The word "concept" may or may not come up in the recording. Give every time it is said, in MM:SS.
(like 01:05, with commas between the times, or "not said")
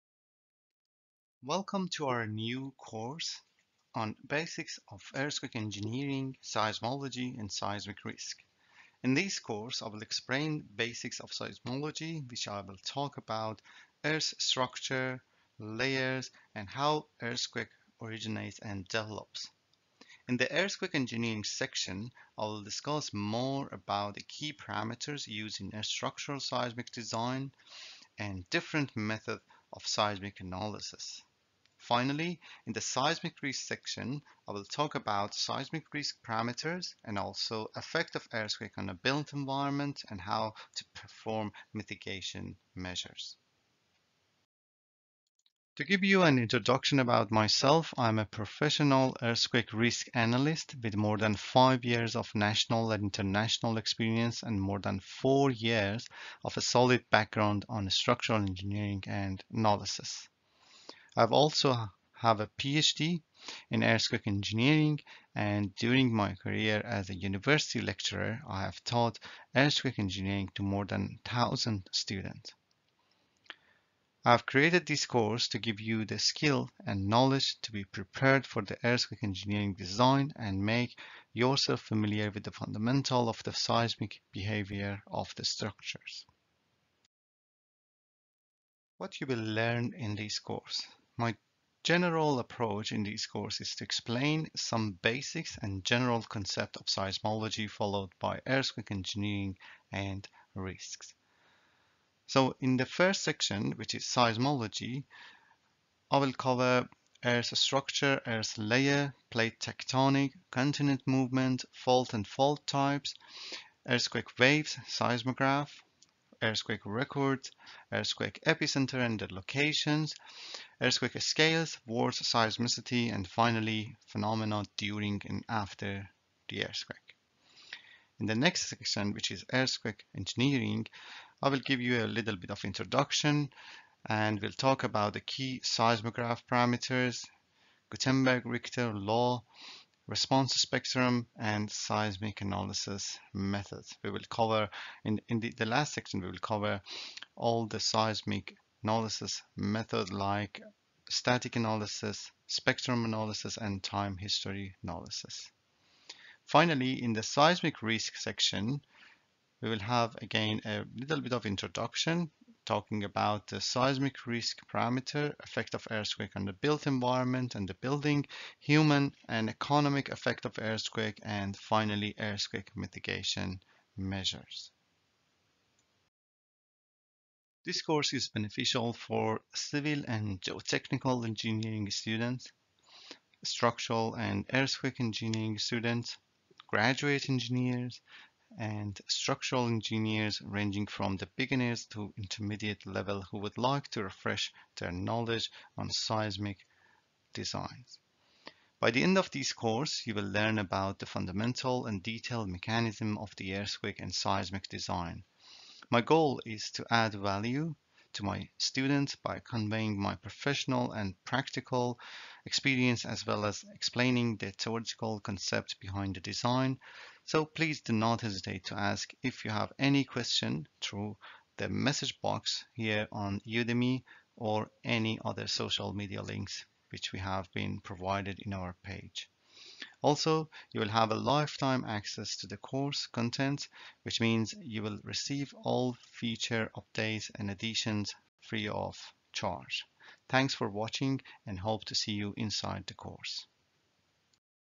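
01:36, 03:35.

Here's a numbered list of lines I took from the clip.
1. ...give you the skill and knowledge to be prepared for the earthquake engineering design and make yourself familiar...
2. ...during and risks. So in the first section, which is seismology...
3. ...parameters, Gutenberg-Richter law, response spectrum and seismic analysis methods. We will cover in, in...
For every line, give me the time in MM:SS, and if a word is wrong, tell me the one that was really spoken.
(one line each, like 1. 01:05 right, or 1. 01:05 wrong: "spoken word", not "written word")
1. 01:15 right
2. 01:38 wrong: "engineering", not "during"
3. 02:16 right.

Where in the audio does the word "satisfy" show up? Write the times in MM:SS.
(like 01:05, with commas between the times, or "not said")
not said.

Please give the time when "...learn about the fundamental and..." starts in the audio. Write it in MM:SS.
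03:20.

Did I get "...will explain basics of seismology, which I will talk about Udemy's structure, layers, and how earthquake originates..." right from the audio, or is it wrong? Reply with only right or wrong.
wrong.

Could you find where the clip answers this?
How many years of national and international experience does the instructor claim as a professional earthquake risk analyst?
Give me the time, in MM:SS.
00:50.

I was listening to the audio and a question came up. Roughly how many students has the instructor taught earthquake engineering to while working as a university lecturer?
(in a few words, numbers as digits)
More than 1,000.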